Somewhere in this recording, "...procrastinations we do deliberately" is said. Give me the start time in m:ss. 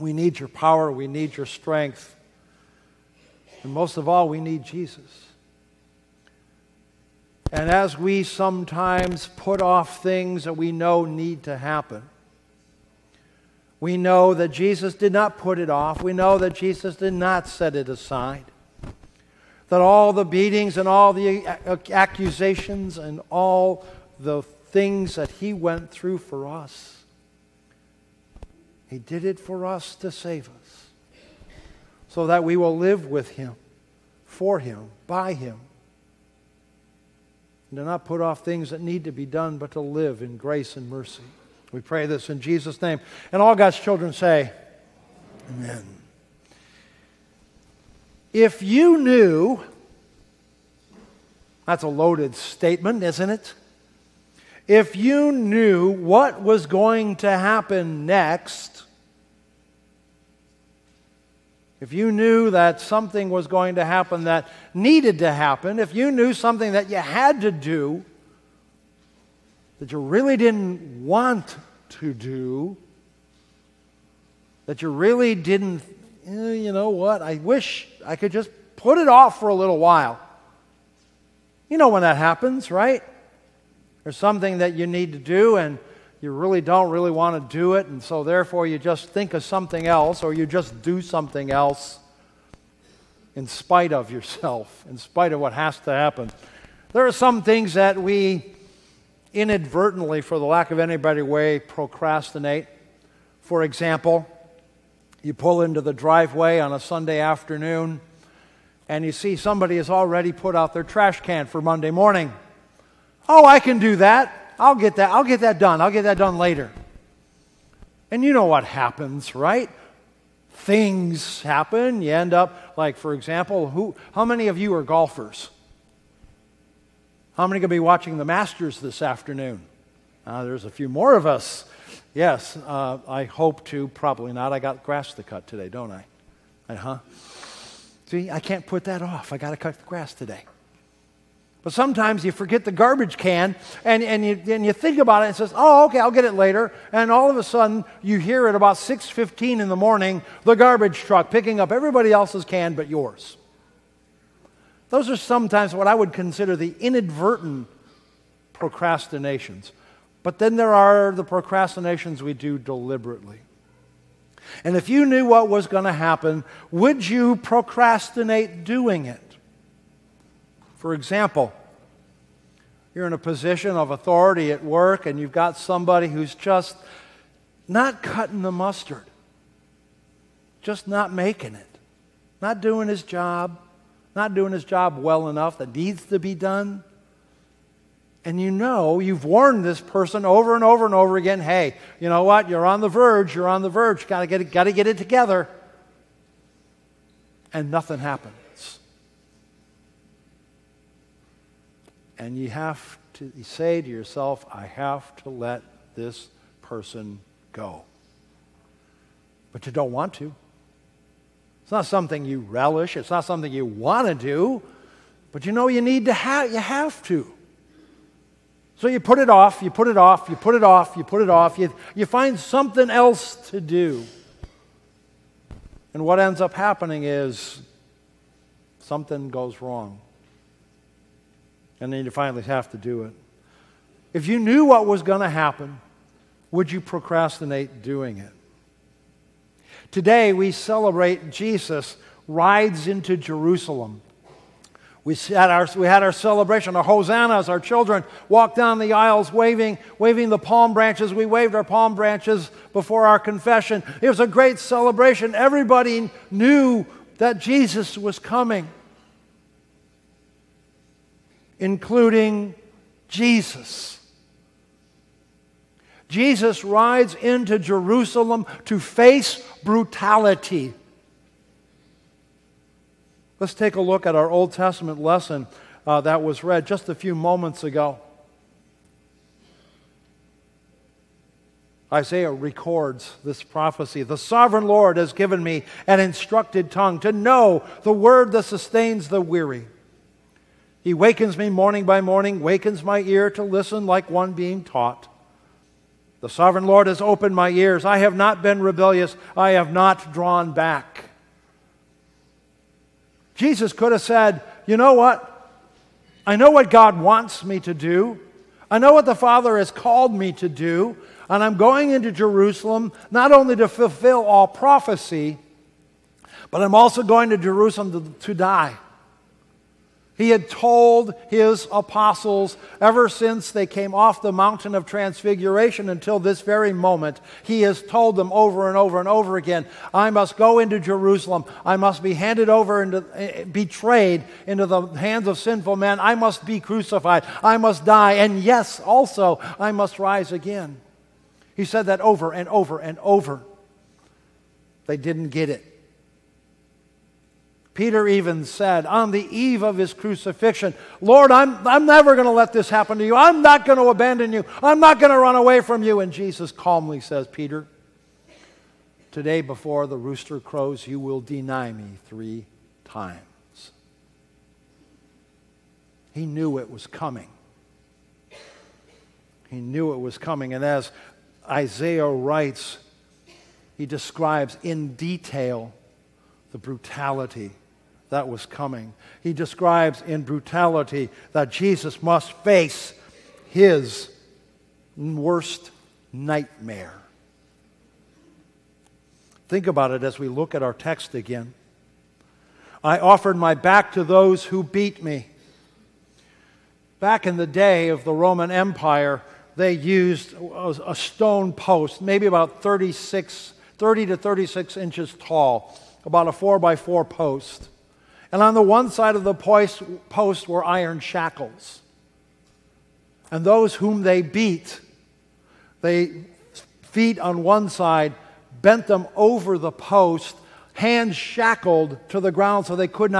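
2:41.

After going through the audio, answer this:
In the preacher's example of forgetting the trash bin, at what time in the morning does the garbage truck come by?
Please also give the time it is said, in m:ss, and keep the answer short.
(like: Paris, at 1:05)
6:15, at 2:28.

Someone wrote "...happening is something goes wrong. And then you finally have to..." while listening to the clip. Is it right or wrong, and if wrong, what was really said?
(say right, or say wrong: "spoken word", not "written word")
right.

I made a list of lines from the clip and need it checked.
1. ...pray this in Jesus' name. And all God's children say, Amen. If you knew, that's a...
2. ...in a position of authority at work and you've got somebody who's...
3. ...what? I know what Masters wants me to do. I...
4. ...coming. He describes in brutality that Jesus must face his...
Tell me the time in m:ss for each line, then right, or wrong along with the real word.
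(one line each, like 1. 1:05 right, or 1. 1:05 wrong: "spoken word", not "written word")
1. 0:41 right
2. 2:53 right
3. 5:04 wrong: "God", not "Masters"
4. 6:18 right.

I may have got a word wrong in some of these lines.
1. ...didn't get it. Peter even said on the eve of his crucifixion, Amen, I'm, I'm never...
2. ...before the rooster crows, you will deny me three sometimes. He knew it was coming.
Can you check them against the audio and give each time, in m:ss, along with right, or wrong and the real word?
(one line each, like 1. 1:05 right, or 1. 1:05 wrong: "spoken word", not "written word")
1. 5:44 wrong: "Lord", not "Amen"
2. 5:59 wrong: "times", not "sometimes".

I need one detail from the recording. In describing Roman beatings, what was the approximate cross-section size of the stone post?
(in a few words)
4 by 4.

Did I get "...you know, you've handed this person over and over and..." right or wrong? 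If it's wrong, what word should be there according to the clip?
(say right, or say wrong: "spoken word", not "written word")
wrong: "warned", not "handed".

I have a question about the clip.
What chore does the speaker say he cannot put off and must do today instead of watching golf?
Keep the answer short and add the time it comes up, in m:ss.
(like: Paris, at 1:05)
Cut the grass, at 2:19.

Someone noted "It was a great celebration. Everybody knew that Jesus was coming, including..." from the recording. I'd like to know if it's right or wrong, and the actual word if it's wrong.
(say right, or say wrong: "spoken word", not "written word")
right.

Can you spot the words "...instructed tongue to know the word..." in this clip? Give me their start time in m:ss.
4:45.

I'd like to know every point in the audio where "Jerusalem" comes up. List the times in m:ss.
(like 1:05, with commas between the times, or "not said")
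4:03, 4:27, 5:12, 5:17, 5:30.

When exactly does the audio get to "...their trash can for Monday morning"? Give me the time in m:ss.
1:50.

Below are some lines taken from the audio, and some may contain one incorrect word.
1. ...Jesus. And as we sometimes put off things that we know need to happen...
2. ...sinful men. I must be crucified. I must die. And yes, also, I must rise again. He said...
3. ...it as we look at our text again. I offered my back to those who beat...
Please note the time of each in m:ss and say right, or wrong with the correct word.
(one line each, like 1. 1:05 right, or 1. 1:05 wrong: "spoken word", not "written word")
1. 0:04 right
2. 5:35 right
3. 6:29 right.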